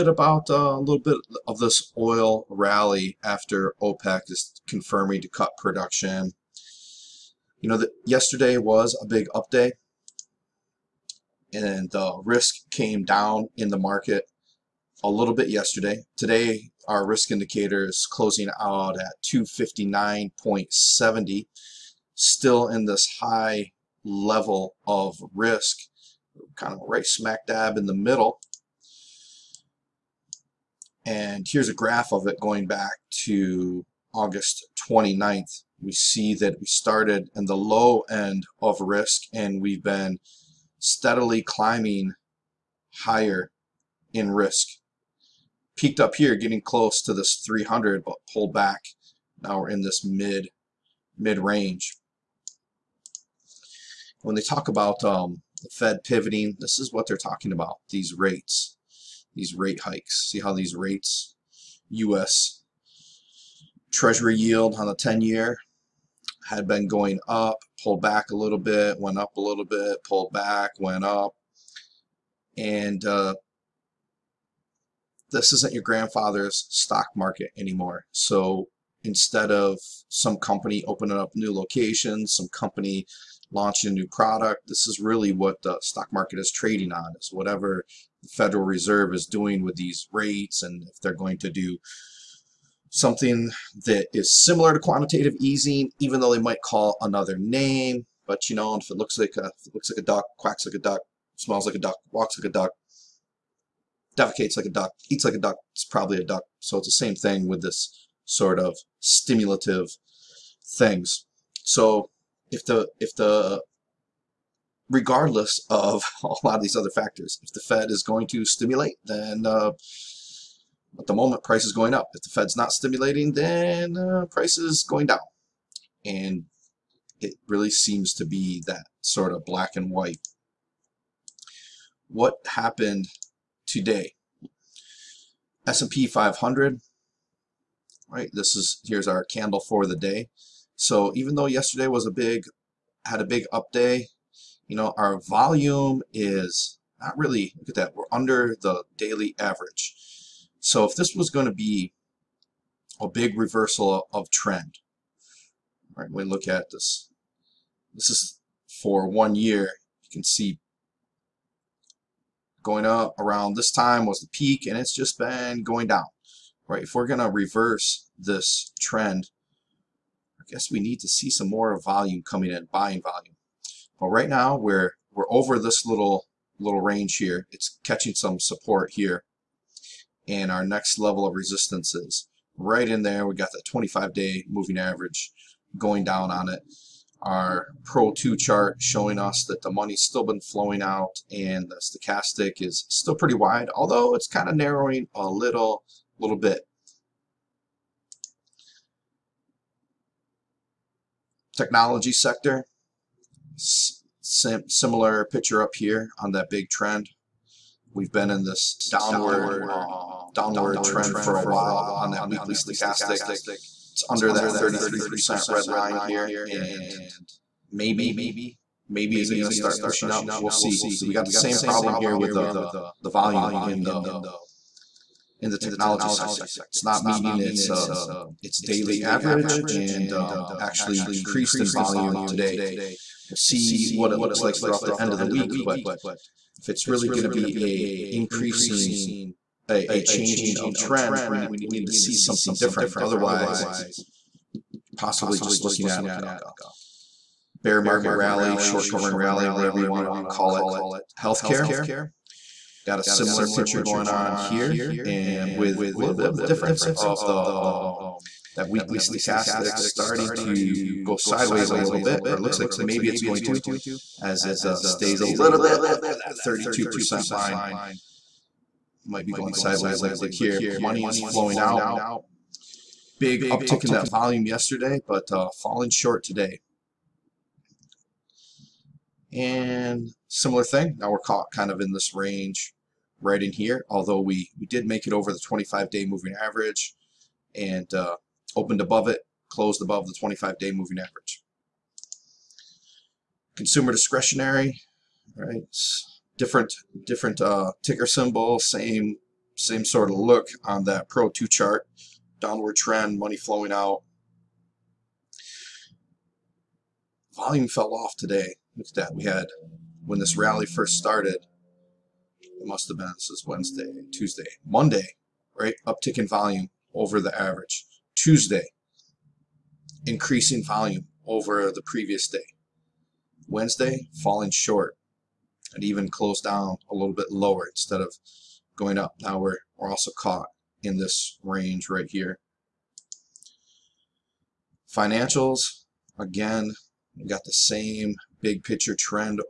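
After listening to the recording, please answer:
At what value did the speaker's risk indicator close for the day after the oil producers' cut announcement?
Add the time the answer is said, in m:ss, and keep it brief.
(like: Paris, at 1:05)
259.70, at 0:19.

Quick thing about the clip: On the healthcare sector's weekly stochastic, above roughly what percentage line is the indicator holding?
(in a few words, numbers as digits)
32%.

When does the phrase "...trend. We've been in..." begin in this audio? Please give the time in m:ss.
3:26.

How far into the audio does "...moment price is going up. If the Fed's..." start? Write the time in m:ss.
2:01.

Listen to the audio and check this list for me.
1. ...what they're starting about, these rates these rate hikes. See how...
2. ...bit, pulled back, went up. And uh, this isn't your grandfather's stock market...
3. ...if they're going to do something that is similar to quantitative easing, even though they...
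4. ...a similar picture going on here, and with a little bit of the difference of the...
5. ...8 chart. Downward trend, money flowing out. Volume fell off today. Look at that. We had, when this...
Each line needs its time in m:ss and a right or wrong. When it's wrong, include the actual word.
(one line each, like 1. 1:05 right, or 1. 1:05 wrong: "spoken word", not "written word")
1. 0:56 wrong: "talking", not "starting"
2. 1:09 right
3. 1:30 right
4. 4:12 right
5. 5:01 wrong: "2", not "8".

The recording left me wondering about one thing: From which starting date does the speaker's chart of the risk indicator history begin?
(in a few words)
August 29th.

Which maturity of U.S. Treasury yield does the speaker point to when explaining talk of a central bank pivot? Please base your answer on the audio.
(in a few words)
10-year.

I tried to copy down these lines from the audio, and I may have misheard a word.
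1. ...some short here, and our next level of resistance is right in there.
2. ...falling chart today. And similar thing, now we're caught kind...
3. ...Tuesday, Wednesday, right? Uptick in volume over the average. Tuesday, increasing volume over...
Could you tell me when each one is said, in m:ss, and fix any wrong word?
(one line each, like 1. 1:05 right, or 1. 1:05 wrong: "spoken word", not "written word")
1. 2:58 wrong: "support", not "short"
2. 4:35 wrong: "short", not "chart"
3. 5:14 wrong: "Monday", not "Wednesday".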